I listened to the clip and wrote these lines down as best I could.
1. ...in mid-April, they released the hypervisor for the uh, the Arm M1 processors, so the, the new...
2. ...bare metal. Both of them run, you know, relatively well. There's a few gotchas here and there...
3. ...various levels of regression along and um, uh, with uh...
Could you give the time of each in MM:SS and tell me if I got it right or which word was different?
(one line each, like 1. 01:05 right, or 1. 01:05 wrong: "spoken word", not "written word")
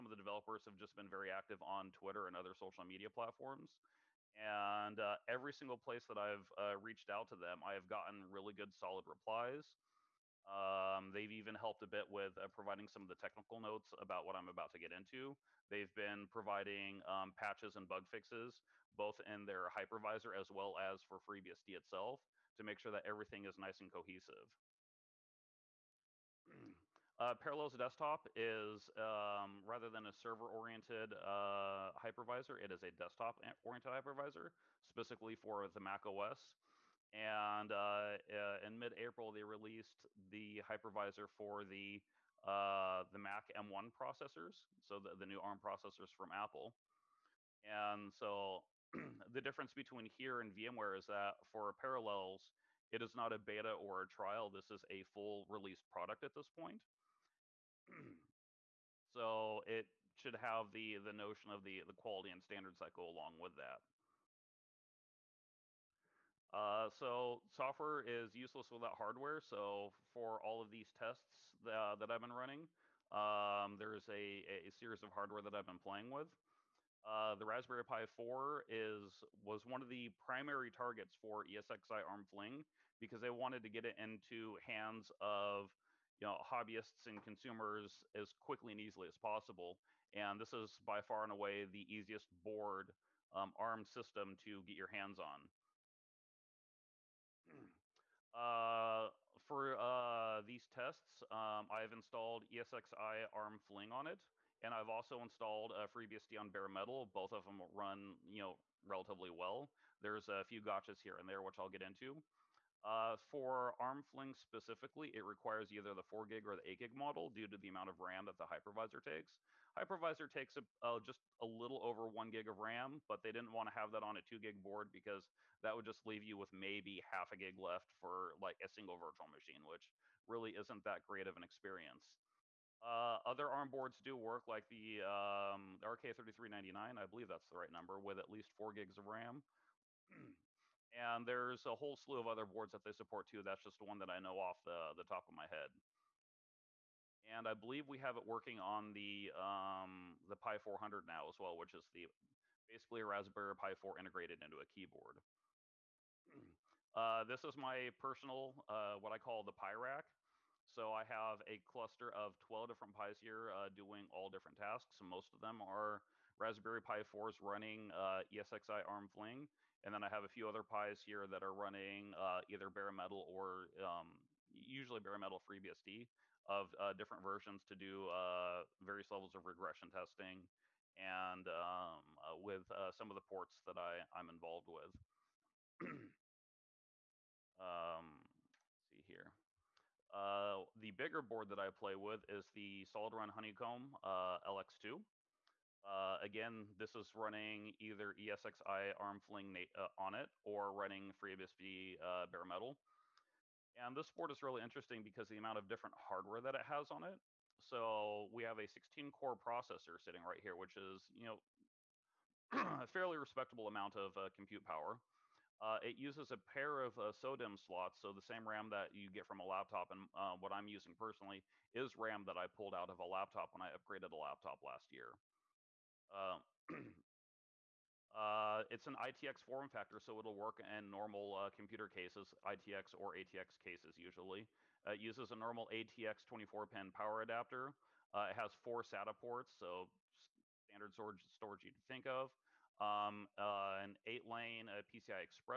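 1. 00:38 wrong: "Mac", not "Arm"
2. 01:46 right
3. 02:58 wrong: "testing", not "along".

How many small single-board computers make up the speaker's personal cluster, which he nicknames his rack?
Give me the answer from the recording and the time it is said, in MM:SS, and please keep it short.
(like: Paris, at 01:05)
12, at 02:42.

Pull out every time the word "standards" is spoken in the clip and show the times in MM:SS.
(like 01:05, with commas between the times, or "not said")
01:02, 04:00.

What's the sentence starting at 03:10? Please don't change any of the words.
Uh, the bigger board that I play with is the SolidRun Honeycomb LX2.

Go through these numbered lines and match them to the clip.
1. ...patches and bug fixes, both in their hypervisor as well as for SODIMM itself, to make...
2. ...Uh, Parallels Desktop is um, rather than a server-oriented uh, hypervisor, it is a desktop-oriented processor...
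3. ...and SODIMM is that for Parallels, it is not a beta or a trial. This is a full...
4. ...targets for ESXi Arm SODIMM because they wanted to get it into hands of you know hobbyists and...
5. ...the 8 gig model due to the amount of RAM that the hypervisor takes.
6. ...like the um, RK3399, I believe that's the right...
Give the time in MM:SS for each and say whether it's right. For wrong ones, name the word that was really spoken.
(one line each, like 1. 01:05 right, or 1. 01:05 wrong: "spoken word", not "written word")
1. 00:17 wrong: "FreeBSD", not "SODIMM"
2. 00:27 wrong: "hypervisor", not "processor"
3. 00:50 wrong: "VMware", not "SODIMM"
4. 01:20 wrong: "Fling", not "SODIMM"
5. 01:56 right
6. 02:14 right.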